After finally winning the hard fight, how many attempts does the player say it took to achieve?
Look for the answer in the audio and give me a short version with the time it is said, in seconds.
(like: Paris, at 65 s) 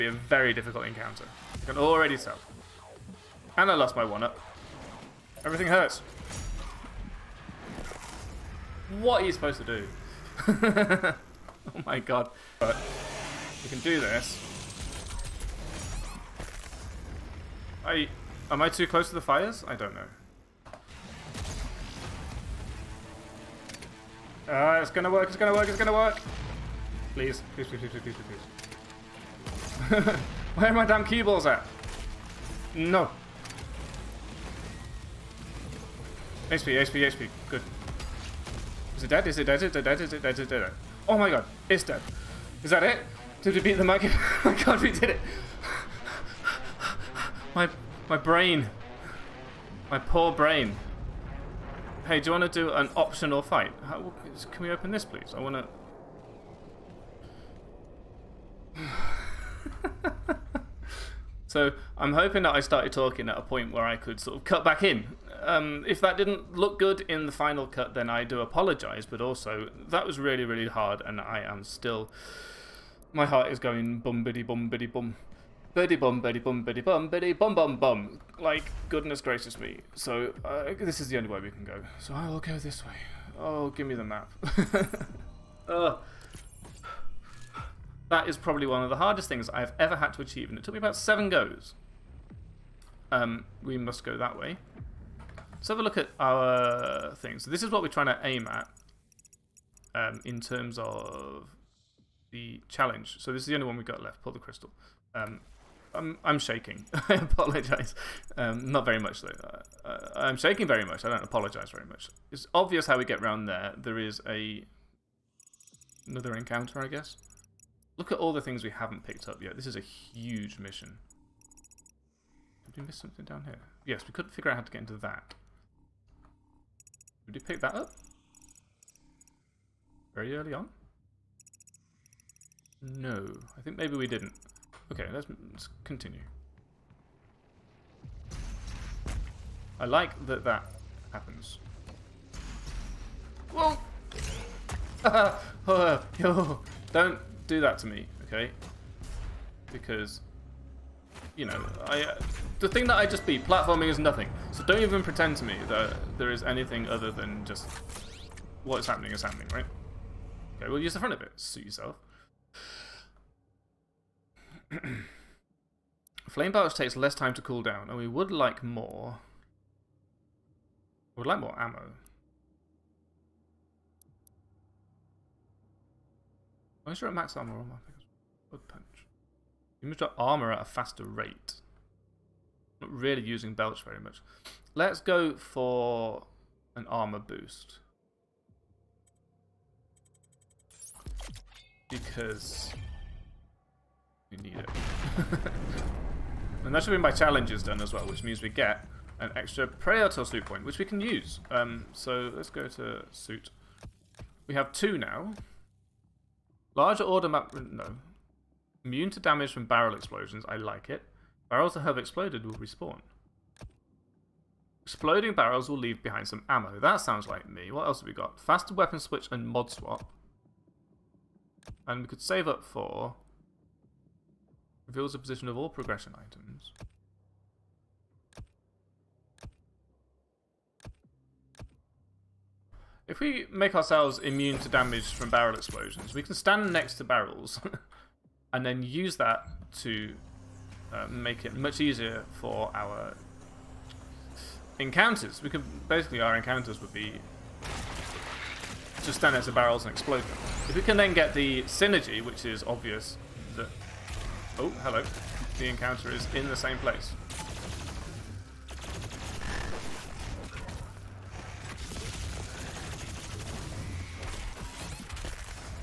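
7, at 90 s.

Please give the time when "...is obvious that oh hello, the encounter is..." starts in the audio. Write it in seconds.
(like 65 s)
252 s.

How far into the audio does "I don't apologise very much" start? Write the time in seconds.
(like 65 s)
111 s.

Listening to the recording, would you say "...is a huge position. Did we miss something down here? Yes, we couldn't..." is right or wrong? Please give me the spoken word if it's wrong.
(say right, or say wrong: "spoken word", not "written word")
wrong: "mission", not "position".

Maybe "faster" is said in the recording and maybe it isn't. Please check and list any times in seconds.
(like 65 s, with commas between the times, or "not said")
180 s, 218 s.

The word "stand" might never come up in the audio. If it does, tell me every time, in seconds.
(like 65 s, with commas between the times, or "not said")
236 s, 249 s.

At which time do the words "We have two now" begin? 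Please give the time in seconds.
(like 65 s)
204 s.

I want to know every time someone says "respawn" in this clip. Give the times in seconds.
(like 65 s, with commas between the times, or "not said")
212 s.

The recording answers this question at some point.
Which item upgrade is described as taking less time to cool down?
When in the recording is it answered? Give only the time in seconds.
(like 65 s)
166 s.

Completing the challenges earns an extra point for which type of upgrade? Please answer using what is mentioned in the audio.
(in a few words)
Praetor suit.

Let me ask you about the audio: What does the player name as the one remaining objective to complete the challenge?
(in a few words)
Pull the crystal.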